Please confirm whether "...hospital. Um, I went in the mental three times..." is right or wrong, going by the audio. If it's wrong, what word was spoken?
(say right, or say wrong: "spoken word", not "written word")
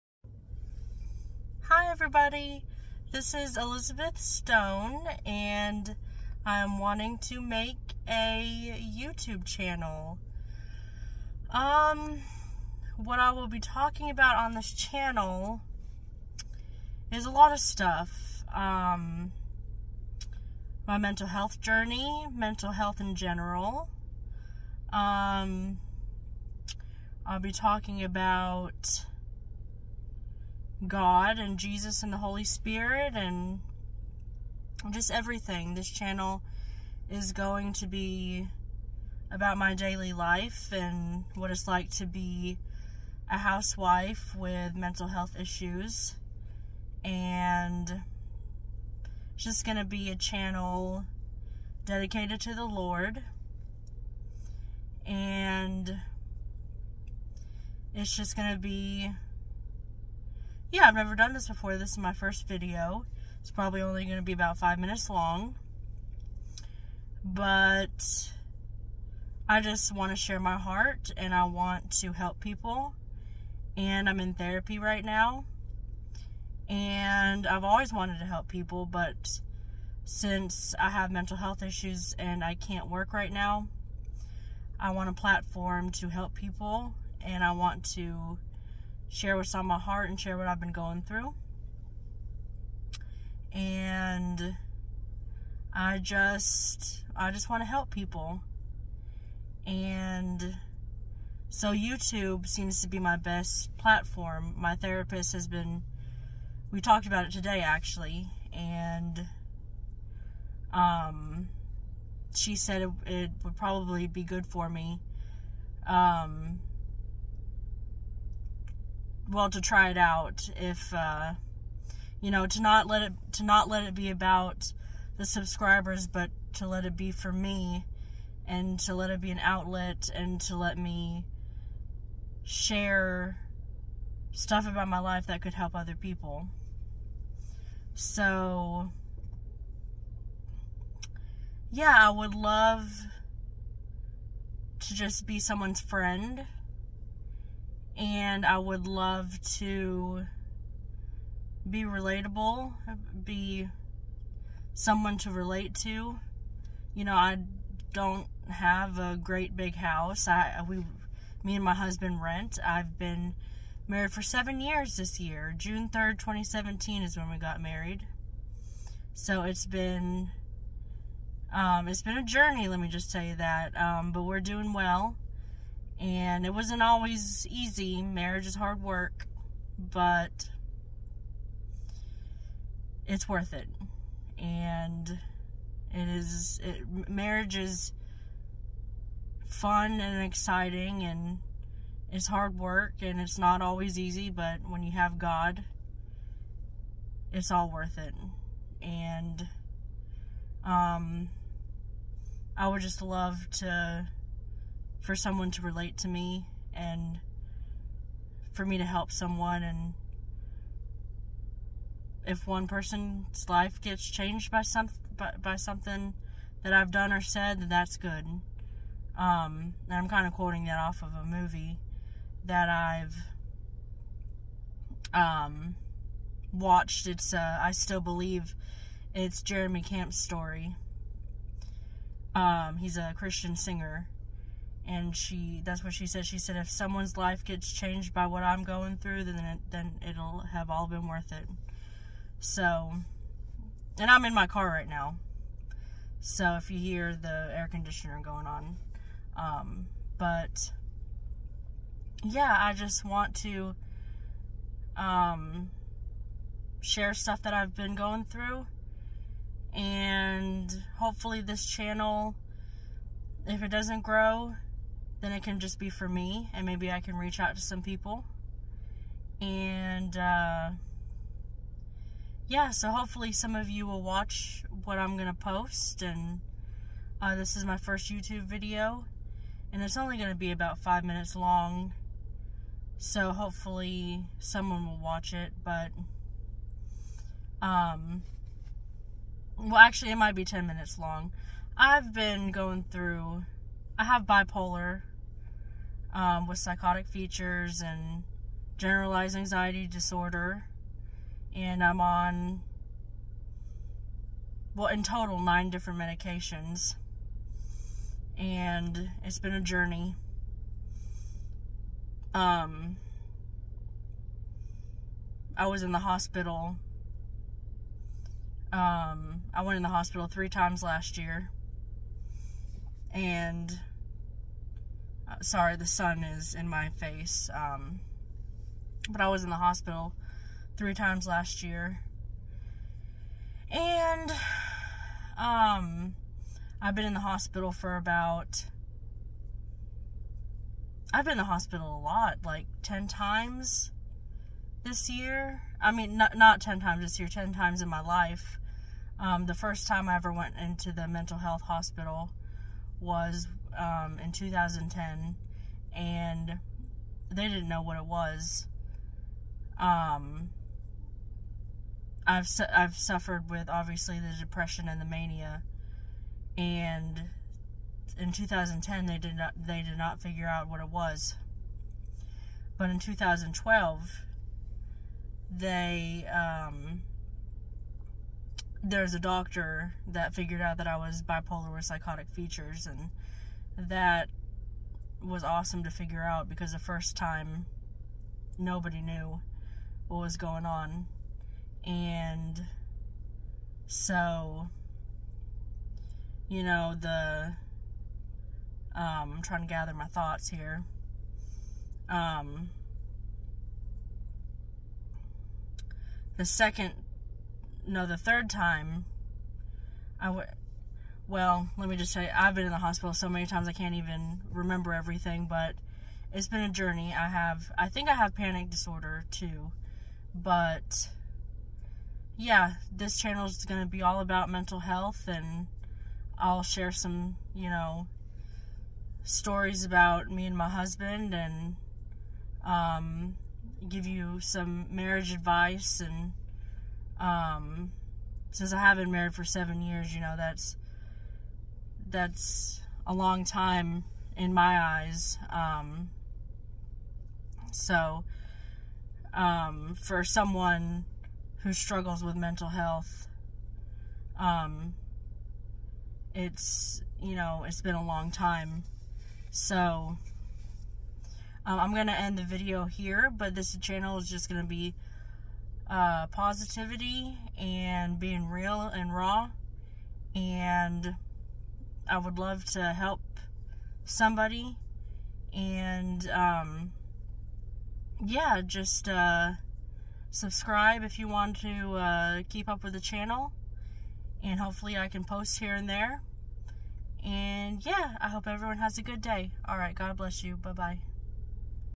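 wrong: "hospital", not "mental".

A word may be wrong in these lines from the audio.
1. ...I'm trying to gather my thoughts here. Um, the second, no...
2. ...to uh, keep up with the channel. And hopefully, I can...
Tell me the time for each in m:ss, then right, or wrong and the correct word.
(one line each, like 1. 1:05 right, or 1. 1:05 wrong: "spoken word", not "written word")
1. 6:39 right
2. 8:01 right.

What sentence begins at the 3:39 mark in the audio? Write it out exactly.
Um, and I'm kind of quoting that off of a movie that I've um, watched.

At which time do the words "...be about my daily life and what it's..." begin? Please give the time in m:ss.
0:37.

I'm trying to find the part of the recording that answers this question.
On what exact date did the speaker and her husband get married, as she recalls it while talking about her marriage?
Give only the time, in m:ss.
2:45.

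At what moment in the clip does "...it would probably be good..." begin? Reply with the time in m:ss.
1:53.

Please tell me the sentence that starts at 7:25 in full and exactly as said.
Um, so, um, for someone who struggles with mental health, um, it's, you know, it's been a long time.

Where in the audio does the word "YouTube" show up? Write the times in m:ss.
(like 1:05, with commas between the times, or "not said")
0:08, 1:41, 4:38.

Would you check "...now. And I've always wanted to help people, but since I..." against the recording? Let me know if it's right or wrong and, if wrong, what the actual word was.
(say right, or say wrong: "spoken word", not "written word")
right.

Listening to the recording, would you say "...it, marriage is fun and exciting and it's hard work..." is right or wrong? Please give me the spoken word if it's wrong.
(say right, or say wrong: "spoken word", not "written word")
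right.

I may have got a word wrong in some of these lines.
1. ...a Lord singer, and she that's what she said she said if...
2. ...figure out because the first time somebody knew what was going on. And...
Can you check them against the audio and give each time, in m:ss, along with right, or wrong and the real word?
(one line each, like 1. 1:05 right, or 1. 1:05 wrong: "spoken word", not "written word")
1. 3:52 wrong: "Christian", not "Lord"
2. 6:25 wrong: "nobody", not "somebody".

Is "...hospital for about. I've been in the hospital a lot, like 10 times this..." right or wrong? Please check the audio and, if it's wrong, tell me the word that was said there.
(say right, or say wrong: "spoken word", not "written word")
right.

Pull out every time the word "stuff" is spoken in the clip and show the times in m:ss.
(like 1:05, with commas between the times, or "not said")
0:17, 2:14, 4:17.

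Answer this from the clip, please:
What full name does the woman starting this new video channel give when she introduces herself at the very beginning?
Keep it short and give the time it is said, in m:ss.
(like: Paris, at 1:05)
Elizabeth Stone, at 0:03.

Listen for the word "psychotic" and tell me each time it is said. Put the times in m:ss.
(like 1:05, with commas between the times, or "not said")
4:56, 6:21.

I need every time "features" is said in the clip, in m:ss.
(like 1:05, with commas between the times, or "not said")
4:57, 6:22.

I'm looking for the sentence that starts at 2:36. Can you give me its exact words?
You know, I don't have a great big house.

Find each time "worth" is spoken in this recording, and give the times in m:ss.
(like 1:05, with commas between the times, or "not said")
3:03, 3:17, 4:01.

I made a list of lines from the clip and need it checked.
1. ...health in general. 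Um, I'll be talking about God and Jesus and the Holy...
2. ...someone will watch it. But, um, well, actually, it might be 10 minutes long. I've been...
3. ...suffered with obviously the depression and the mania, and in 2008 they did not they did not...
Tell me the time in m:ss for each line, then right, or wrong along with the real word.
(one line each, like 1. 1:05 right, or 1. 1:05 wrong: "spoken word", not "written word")
1. 0:22 right
2. 4:44 right
3. 6:02 wrong: "2010", not "2008".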